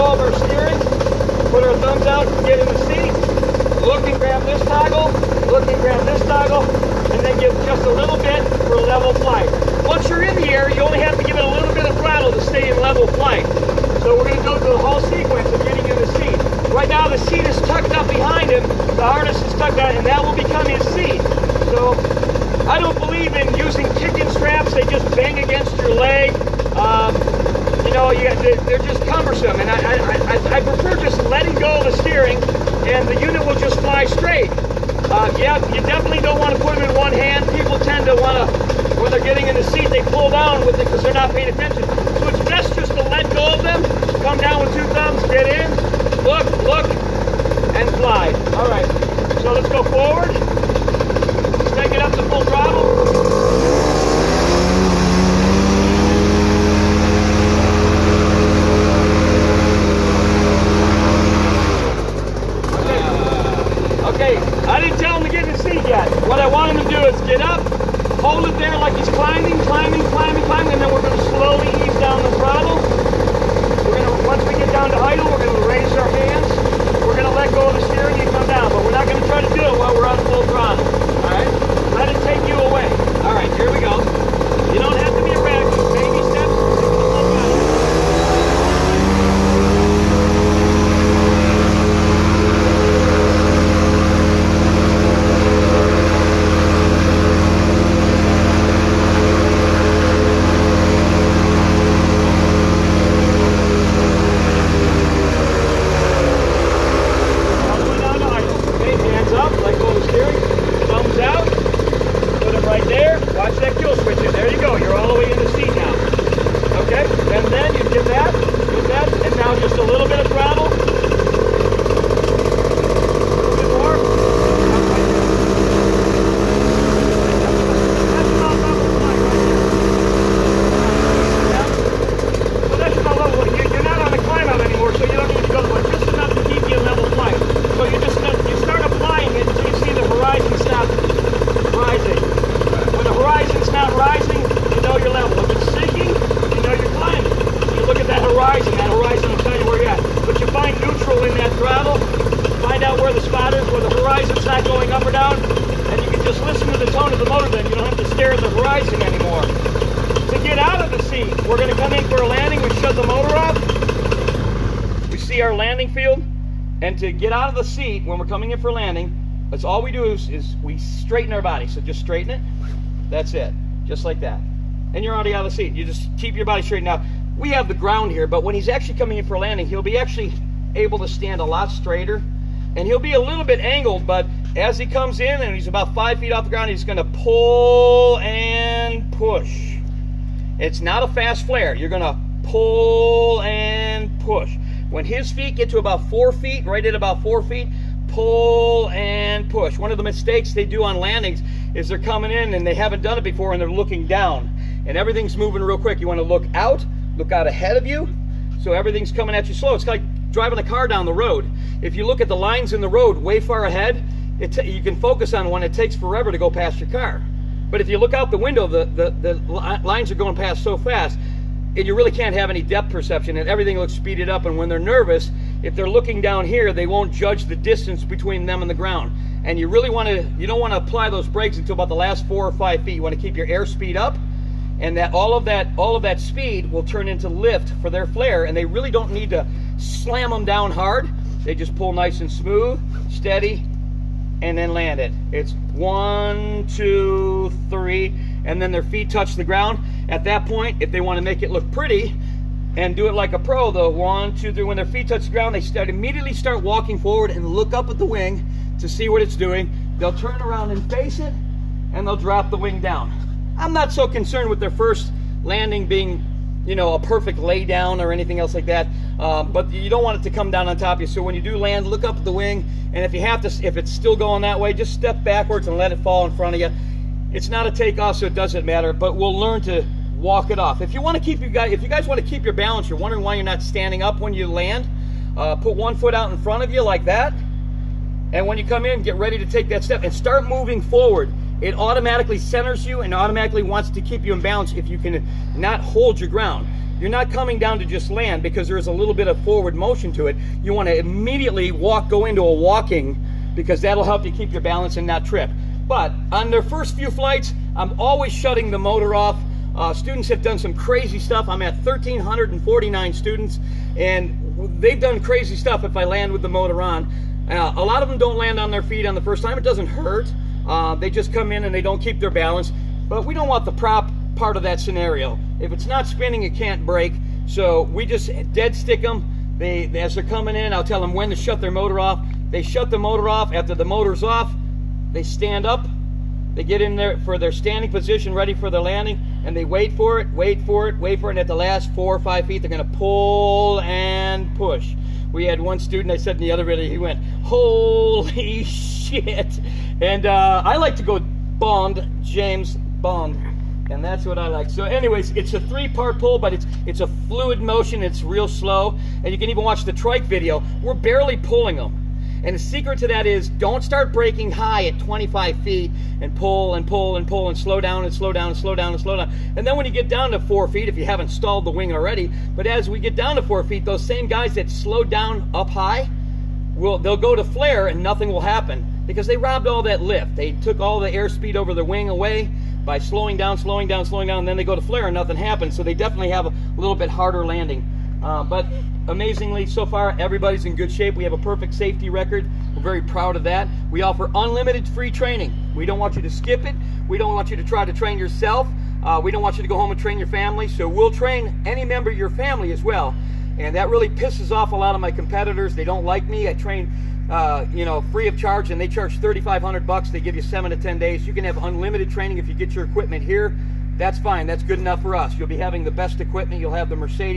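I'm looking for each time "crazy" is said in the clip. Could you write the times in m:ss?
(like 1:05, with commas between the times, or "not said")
5:10, 5:15.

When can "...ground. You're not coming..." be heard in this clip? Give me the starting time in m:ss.
4:56.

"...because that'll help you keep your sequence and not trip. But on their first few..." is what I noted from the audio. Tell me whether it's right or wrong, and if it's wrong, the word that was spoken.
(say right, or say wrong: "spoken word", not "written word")
wrong: "balance", not "sequence".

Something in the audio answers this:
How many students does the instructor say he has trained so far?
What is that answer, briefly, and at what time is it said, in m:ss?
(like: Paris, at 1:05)
1,349, at 5:11.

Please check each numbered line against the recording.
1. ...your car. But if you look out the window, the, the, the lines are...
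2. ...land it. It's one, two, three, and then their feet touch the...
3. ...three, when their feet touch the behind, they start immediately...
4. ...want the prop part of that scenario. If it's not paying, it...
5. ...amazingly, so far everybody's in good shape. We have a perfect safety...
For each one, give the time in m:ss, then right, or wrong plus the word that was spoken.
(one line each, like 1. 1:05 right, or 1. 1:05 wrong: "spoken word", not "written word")
1. 3:36 right
2. 4:04 right
3. 4:14 wrong: "ground", not "behind"
4. 5:23 wrong: "spinning", not "paying"
5. 6:29 right.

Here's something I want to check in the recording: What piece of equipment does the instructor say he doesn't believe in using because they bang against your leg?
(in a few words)
Kicking straps.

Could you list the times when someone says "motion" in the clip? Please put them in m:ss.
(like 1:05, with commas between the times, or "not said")
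4:59, 5:57.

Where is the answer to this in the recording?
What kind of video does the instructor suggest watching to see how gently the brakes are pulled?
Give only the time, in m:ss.
5:59.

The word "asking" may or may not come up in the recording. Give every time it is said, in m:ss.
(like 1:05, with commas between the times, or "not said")
not said.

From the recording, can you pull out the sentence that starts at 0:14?
So we're going to go through the whole sequence of getting in the seat.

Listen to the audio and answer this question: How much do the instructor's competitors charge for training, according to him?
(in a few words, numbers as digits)
$3,500.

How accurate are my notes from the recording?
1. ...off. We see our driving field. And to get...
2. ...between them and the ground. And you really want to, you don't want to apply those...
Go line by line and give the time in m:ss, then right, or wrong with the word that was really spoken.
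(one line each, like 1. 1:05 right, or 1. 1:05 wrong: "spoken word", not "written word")
1. 2:43 wrong: "landing", not "driving"
2. 3:48 right.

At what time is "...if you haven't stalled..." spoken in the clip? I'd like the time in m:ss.
6:10.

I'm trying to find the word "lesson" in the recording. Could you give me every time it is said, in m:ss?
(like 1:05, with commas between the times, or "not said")
not said.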